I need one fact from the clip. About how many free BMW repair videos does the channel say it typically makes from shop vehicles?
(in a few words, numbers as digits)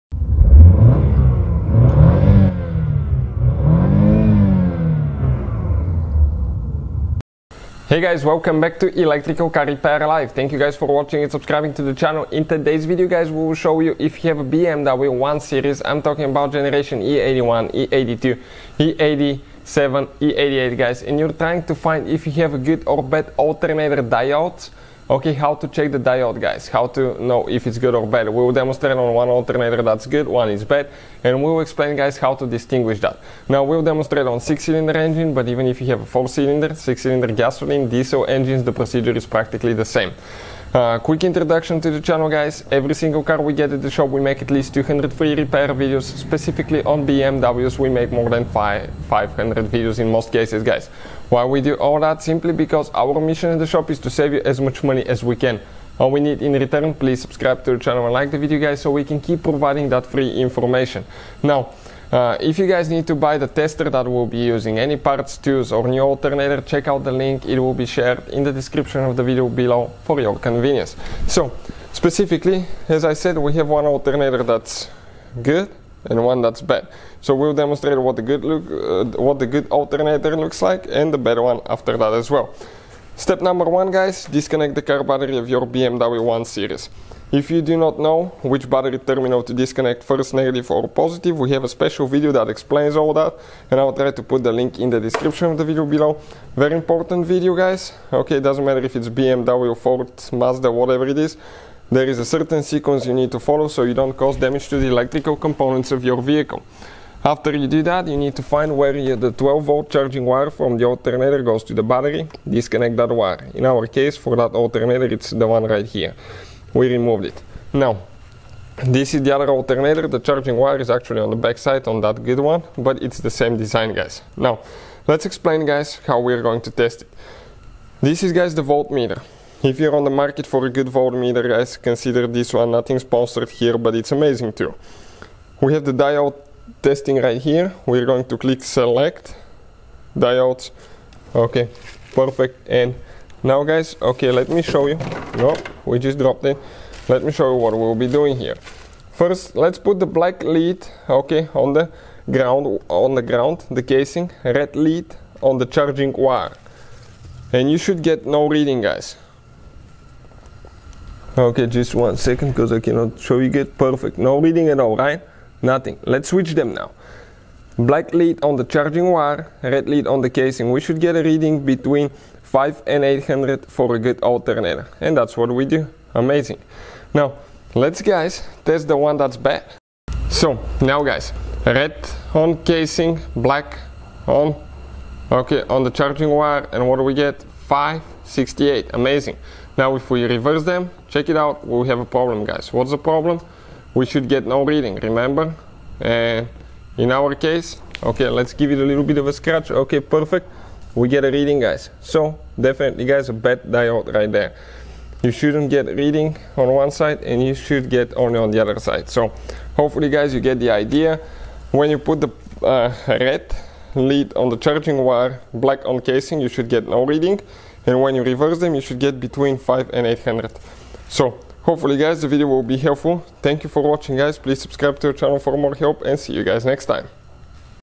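500.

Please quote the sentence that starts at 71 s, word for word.
So, specifically, as I said, we have one alternator that's good and one that's bad.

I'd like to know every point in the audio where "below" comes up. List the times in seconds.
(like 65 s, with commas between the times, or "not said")
69 s, 95 s.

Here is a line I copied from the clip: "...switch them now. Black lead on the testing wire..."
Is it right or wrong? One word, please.
wrong.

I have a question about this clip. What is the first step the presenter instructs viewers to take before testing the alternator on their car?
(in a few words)
disconnect the car battery.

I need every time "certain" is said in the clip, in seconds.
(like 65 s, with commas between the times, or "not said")
102 s.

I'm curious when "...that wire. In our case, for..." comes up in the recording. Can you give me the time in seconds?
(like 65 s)
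112 s.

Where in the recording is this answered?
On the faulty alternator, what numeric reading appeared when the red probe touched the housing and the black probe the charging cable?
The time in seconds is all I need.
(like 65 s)
187 s.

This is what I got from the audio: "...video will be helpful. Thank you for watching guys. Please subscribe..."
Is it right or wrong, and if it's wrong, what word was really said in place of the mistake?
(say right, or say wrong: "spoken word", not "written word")
right.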